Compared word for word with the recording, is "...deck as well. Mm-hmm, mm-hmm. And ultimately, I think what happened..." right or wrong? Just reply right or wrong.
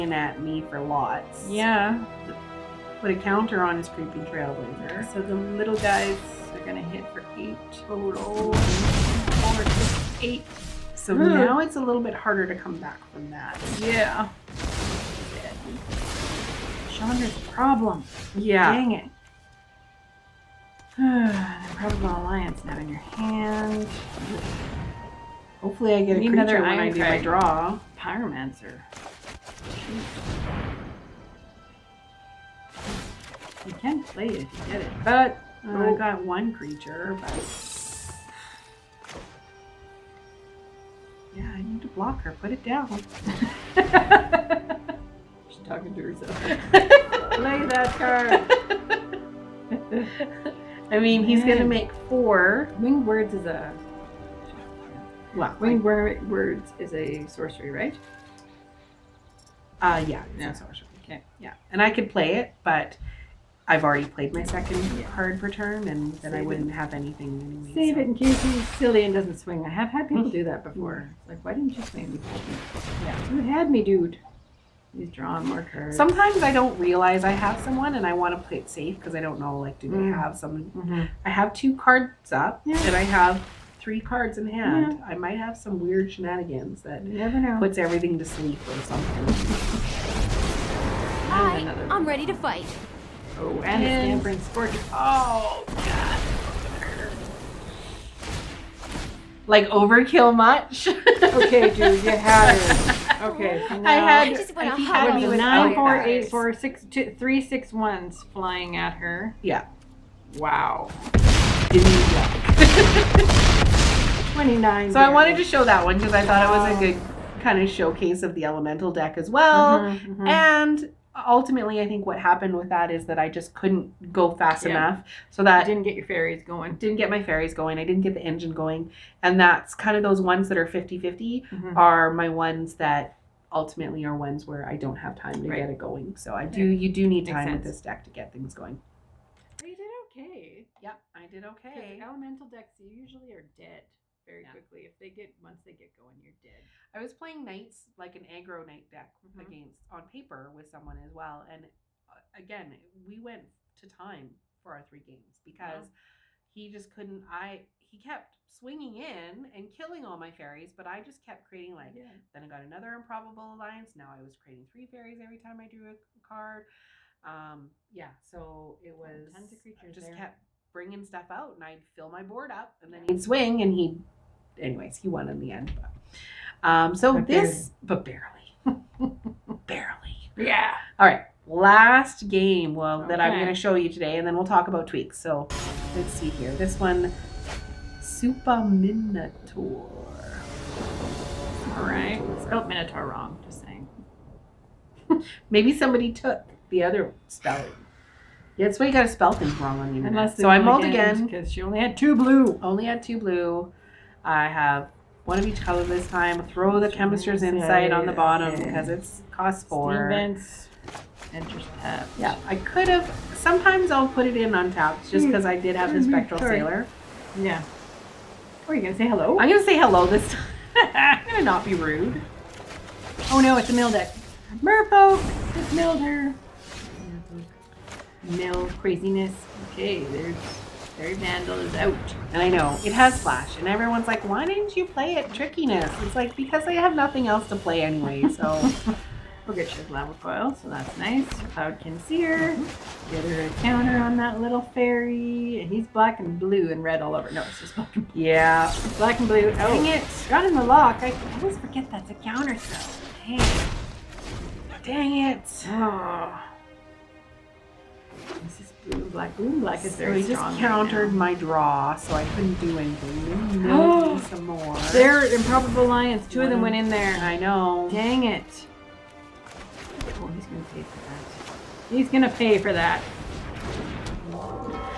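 right.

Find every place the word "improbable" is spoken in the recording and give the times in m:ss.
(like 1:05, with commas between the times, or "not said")
2:42, 4:25.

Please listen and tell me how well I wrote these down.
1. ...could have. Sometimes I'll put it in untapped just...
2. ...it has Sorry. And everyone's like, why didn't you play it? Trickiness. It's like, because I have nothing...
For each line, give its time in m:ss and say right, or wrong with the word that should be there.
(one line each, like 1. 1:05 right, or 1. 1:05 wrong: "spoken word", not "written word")
1. 3:32 right
2. 3:52 wrong: "Flash", not "Sorry".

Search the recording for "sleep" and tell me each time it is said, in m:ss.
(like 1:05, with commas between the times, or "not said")
1:28.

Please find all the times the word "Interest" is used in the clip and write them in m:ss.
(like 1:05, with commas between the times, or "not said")
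3:31.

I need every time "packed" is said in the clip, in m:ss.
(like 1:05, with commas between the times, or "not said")
not said.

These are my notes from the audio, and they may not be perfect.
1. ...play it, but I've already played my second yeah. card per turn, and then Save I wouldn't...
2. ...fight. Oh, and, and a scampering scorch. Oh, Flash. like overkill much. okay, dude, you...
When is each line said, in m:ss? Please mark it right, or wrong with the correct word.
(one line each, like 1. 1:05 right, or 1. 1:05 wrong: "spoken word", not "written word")
1. 1:02 right
2. 1:32 wrong: "God", not "Flash".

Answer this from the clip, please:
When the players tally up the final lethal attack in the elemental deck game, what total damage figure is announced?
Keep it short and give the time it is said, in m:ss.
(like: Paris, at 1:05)
29, at 1:54.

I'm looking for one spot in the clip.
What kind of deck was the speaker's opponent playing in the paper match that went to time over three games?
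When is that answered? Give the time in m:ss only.
2:28.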